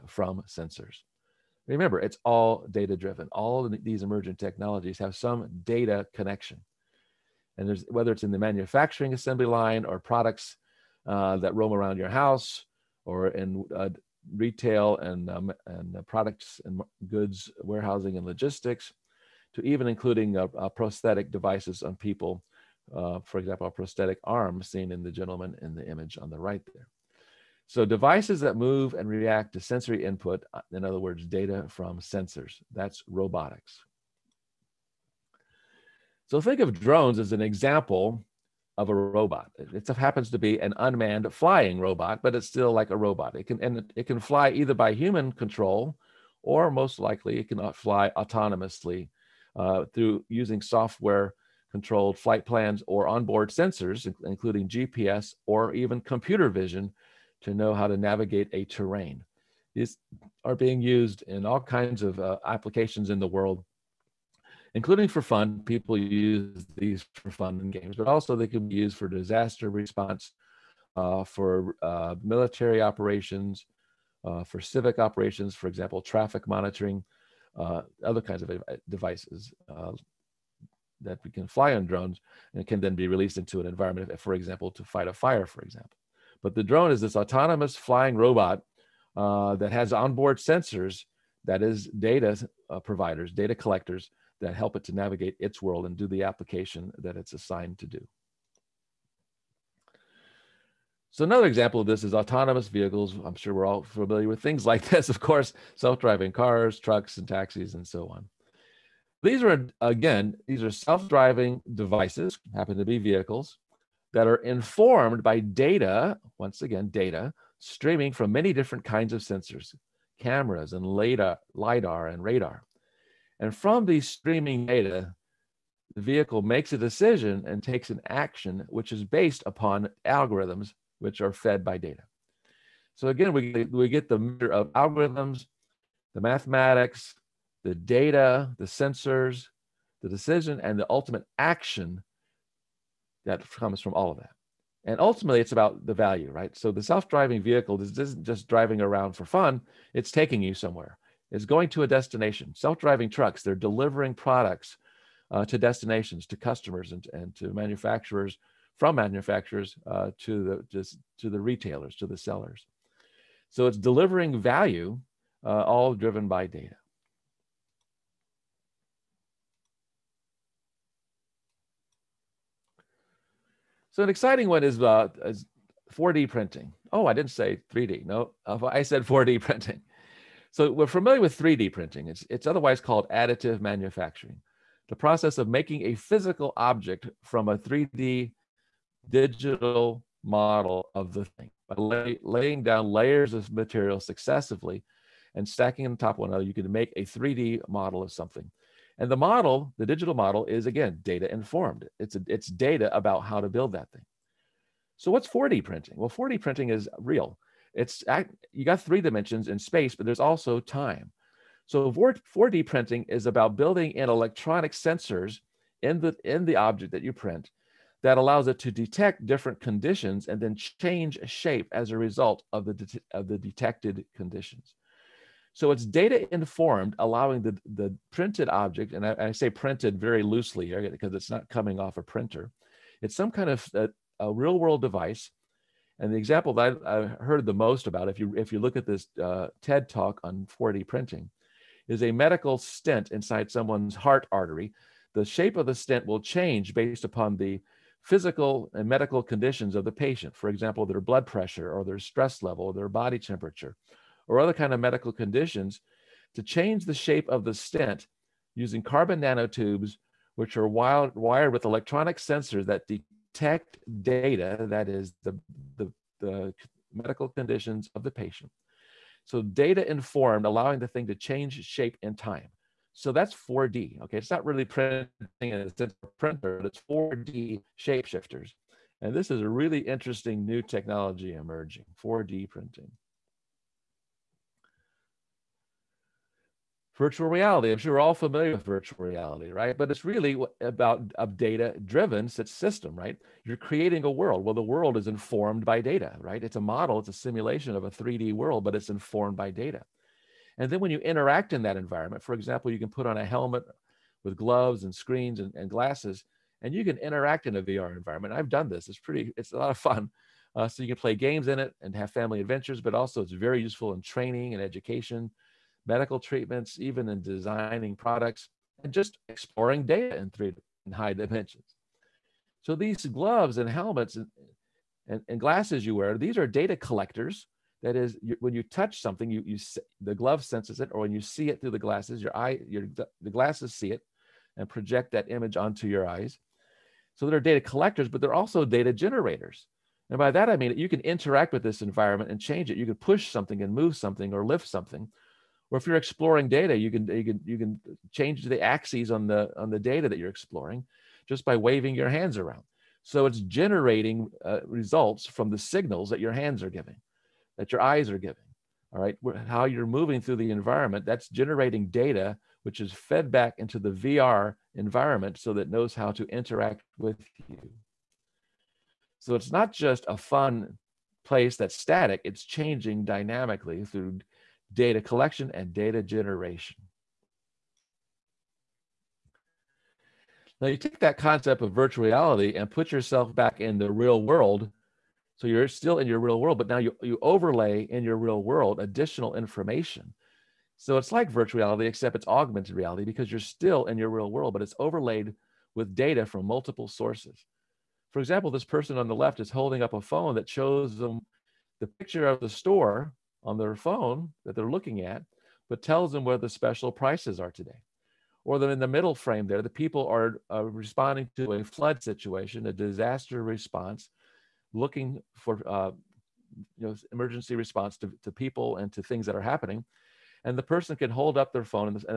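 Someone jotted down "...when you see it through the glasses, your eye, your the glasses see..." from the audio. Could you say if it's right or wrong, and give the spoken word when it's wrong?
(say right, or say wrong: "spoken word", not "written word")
right.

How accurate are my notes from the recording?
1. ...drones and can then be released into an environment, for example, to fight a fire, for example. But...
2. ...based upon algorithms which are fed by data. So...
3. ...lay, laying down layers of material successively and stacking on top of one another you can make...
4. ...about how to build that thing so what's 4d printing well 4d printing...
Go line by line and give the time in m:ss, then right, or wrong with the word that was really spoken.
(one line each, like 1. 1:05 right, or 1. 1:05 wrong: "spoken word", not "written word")
1. 1:21 right
2. 2:09 right
3. 3:11 right
4. 3:22 right.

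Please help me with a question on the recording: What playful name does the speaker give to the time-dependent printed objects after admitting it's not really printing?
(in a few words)
4D shapeshifters.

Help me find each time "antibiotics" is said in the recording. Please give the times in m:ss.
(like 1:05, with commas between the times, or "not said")
not said.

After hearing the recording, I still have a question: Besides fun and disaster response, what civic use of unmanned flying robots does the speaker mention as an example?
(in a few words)
traffic monitoring.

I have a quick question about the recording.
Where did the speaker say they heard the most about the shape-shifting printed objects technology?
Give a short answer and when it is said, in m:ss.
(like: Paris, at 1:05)
TED talk, at 3:59.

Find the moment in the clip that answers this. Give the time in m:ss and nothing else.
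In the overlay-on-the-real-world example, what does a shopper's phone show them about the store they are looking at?
6:46.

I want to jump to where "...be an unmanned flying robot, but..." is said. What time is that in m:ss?
0:40.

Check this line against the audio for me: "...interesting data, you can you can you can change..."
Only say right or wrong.
wrong.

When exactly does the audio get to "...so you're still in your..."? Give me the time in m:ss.
6:25.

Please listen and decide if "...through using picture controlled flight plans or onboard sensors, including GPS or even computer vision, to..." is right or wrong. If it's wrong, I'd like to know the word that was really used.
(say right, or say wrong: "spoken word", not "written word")
wrong: "software", not "picture".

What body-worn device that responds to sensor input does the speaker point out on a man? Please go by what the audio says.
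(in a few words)
prosthetic arm.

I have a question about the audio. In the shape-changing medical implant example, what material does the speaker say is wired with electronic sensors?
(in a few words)
carbon nanotubes.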